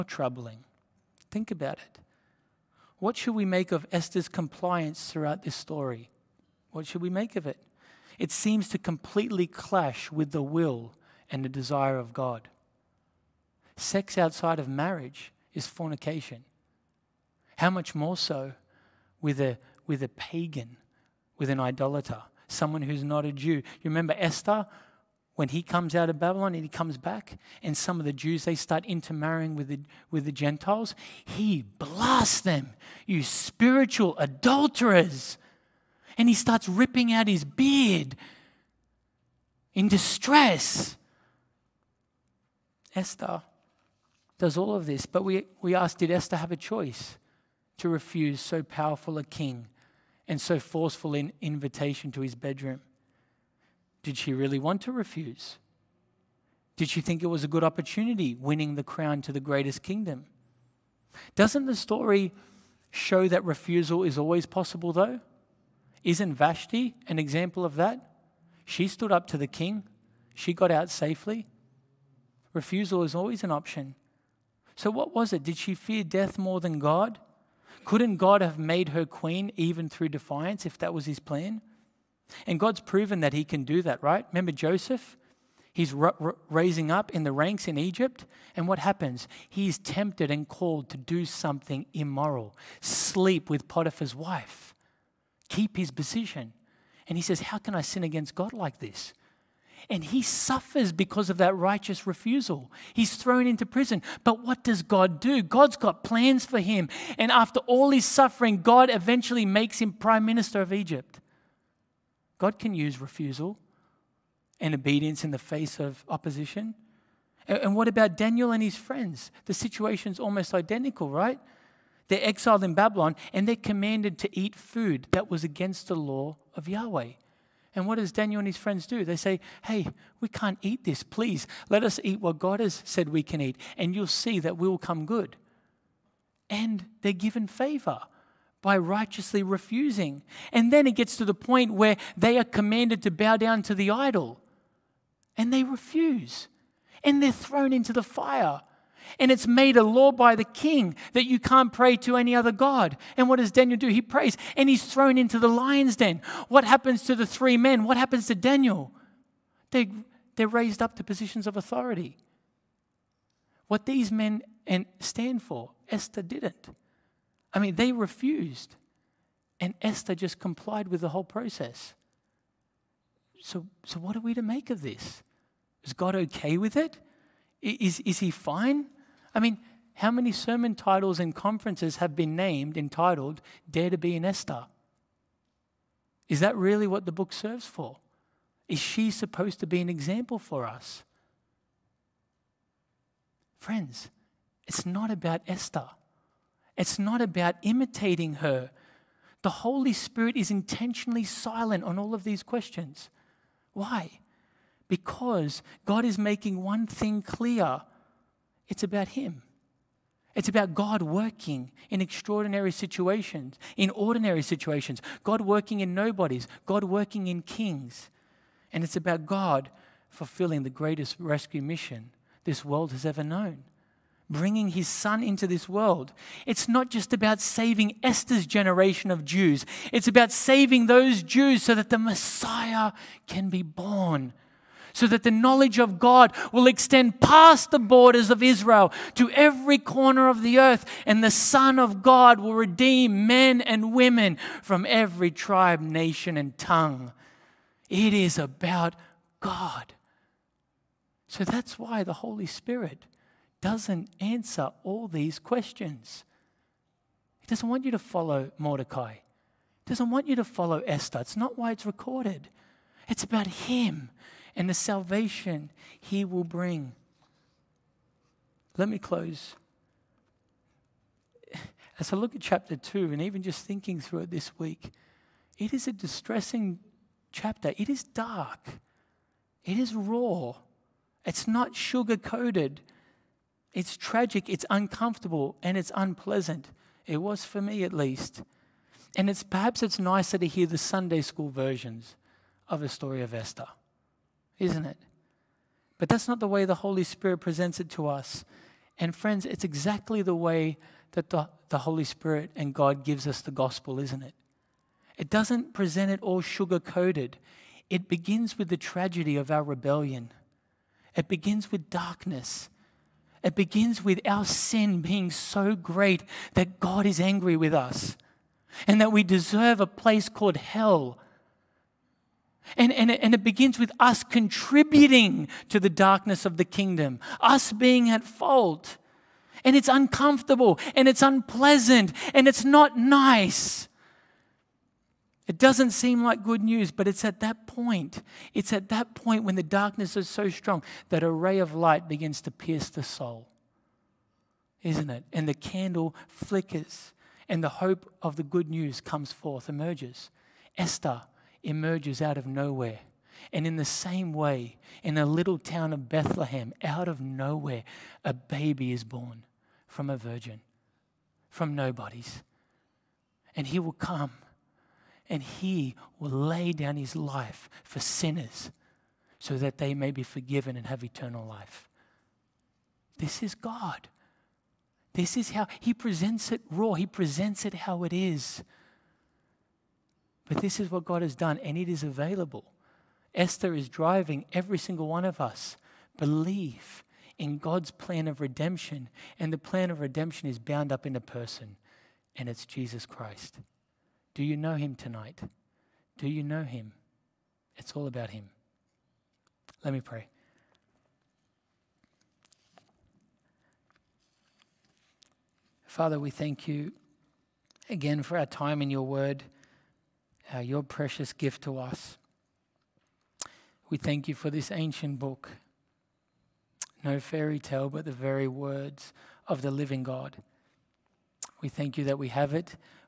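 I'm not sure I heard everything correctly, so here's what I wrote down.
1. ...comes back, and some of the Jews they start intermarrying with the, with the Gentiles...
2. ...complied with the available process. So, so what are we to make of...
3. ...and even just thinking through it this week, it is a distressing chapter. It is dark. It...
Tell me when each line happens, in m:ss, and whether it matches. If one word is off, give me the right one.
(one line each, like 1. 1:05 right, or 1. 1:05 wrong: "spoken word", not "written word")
1. 0:26 right
2. 2:50 wrong: "whole", not "available"
3. 4:33 right.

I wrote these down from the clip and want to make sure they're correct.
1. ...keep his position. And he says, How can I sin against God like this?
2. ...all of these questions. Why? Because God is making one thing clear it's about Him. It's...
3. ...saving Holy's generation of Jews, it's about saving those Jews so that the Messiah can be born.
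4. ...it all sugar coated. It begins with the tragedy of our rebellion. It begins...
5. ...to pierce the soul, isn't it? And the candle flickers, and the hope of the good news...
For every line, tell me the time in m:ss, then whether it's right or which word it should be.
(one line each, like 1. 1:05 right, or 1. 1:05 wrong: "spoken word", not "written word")
1. 1:35 right
2. 3:21 right
3. 3:47 wrong: "Esther", not "Holy"
4. 5:06 right
5. 5:42 right.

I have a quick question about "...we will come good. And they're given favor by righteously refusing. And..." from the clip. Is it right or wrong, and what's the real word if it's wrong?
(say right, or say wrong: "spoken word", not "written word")
right.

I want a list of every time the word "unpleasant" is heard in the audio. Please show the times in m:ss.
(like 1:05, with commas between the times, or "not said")
4:45, 5:31.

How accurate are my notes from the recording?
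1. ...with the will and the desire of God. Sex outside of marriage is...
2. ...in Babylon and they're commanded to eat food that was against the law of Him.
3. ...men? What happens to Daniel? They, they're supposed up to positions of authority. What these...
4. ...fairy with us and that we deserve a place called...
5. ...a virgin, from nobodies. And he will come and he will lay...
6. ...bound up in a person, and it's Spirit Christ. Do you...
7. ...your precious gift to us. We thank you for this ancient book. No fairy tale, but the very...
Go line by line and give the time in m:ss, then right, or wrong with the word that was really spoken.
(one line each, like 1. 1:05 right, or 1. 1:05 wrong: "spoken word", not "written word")
1. 0:10 right
2. 2:02 wrong: "Yahweh", not "Him"
3. 2:37 wrong: "raised", not "supposed"
4. 5:17 wrong: "angry", not "fairy"
5. 6:00 right
6. 6:30 wrong: "Jesus", not "Spirit"
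7. 6:50 right.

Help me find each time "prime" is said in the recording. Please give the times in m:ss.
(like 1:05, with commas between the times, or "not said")
1:49.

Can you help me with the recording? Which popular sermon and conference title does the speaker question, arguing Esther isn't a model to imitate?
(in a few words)
Dare to be an Esther.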